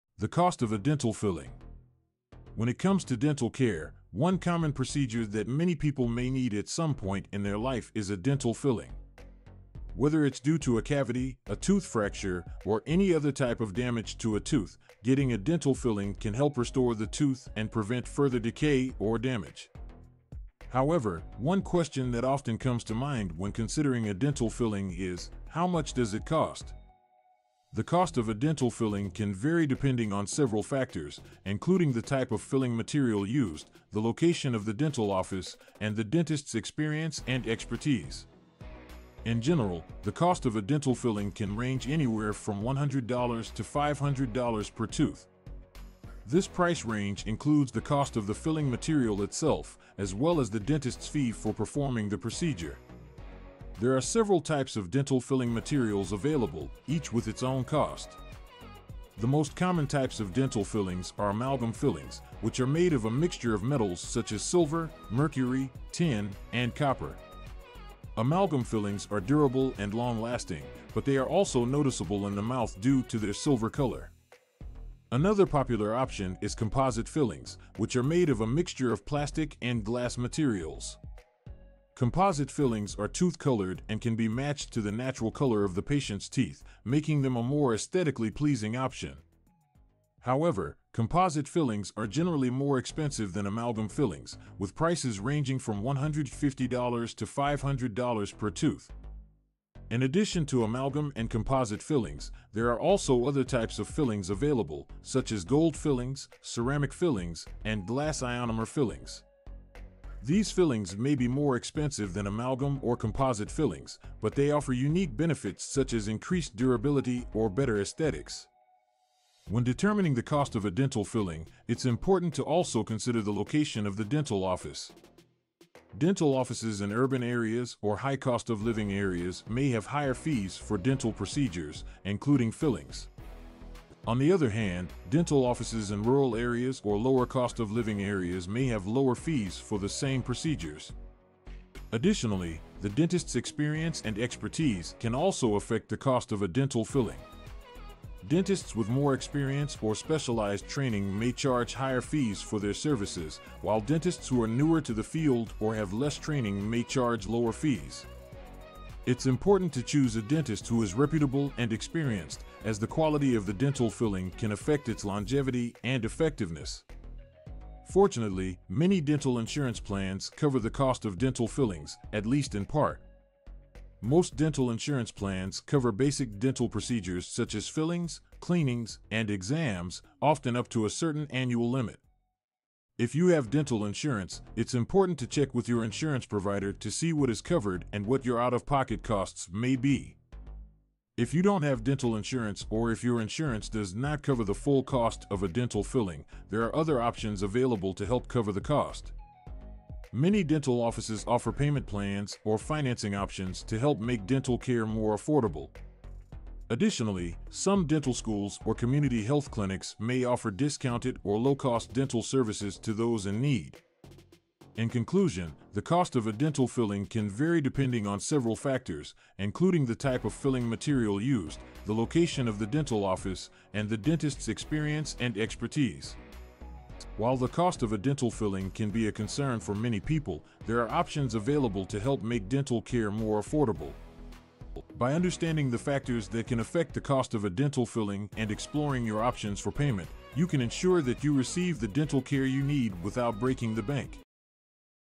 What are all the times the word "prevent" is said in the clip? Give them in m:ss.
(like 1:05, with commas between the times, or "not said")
0:17.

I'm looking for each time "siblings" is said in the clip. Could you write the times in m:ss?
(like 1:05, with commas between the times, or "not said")
not said.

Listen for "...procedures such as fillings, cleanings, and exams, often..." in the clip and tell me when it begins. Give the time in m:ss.
2:56.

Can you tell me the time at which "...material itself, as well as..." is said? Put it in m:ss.
0:48.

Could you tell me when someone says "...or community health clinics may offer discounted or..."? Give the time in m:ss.
3:28.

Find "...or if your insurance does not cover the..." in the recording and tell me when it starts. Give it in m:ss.
3:12.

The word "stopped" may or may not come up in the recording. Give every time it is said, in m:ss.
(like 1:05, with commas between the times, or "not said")
not said.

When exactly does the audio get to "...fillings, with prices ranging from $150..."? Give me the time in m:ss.
1:33.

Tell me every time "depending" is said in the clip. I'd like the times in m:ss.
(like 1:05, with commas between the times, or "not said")
0:29, 3:37.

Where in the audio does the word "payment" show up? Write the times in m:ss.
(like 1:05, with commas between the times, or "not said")
3:21, 3:59.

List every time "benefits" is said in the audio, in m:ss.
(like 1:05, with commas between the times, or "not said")
1:55.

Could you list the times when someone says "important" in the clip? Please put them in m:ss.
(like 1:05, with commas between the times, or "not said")
2:01, 2:39, 3:04.